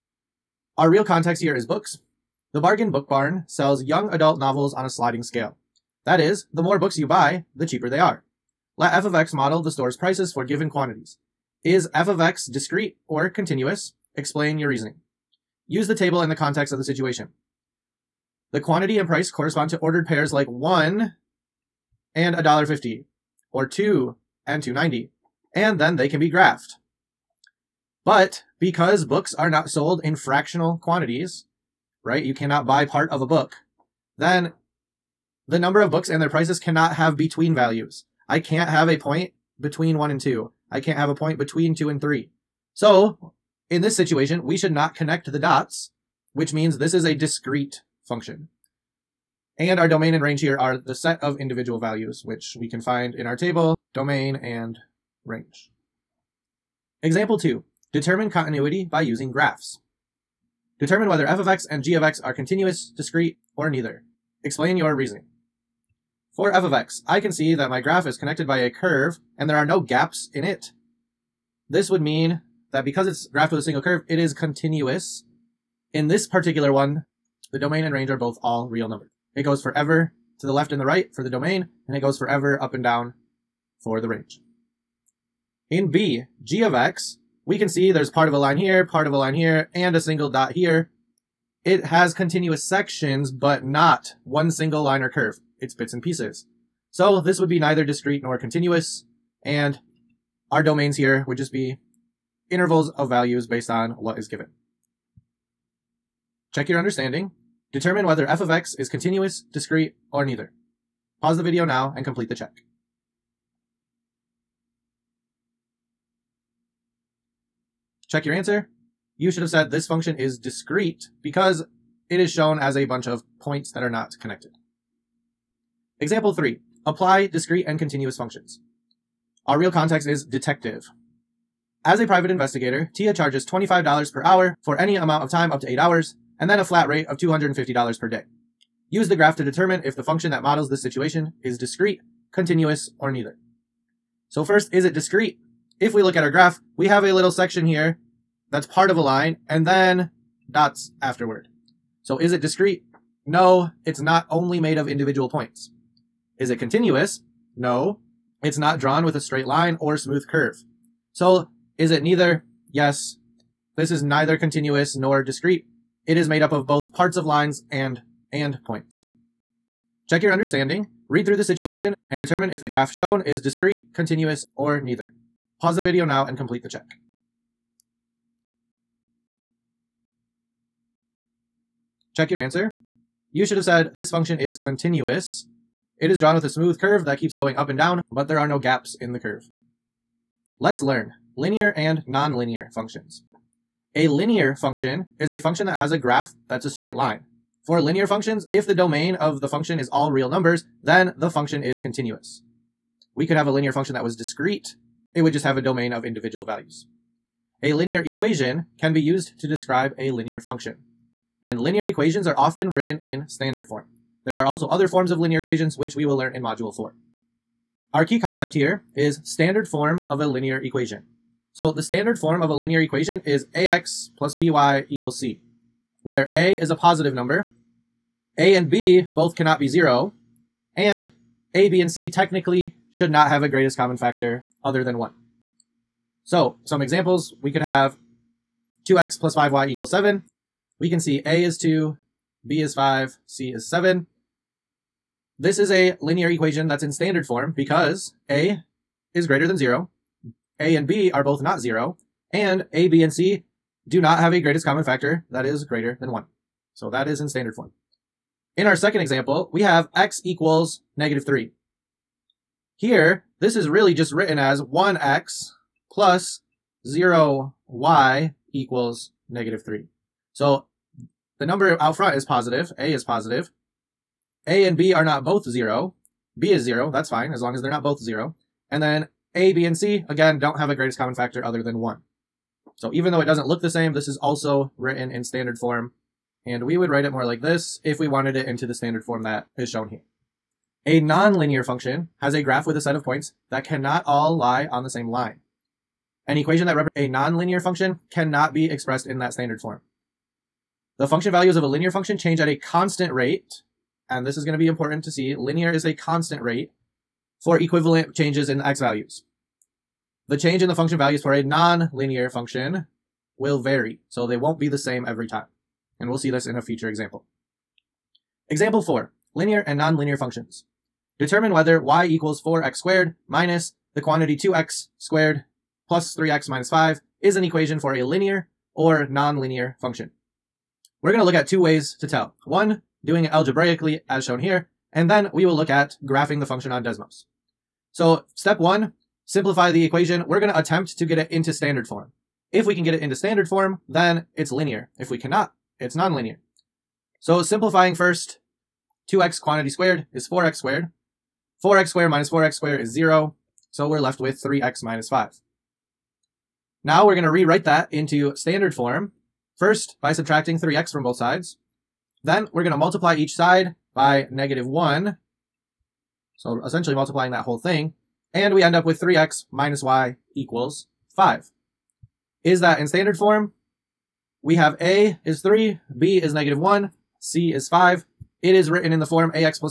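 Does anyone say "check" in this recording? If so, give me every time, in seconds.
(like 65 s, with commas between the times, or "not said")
106 s, 112 s, 118 s, 170 s, 176 s, 182 s.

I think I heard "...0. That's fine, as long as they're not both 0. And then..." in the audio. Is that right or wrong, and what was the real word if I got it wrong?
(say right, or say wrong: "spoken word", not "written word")
right.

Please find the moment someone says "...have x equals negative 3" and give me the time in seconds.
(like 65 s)
259 s.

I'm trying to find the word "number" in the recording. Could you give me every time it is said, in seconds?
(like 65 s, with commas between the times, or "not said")
35 s, 78 s, 200 s, 227 s, 271 s.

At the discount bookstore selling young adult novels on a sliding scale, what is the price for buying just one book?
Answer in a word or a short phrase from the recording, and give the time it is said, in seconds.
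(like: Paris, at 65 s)
$1.50, at 22 s.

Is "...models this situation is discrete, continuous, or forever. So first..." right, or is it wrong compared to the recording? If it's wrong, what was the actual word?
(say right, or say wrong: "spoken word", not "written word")
wrong: "neither", not "forever".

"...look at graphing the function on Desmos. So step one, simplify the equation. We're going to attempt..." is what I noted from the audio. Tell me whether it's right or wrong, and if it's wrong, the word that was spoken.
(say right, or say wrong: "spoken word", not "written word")
right.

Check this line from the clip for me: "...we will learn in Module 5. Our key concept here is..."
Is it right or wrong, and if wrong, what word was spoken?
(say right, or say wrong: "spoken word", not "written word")
wrong: "4", not "5".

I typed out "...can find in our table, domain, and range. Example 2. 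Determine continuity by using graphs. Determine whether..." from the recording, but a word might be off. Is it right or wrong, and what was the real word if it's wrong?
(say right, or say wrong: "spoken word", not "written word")
right.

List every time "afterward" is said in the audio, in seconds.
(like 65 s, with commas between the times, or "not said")
151 s.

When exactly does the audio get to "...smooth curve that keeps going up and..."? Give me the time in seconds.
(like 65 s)
186 s.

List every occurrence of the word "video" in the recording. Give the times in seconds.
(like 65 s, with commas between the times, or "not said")
111 s, 175 s.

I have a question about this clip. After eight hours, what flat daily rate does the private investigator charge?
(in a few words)
$250.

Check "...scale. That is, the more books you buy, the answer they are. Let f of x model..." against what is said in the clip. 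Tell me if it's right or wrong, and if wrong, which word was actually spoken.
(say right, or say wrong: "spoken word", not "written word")
wrong: "cheaper", not "answer".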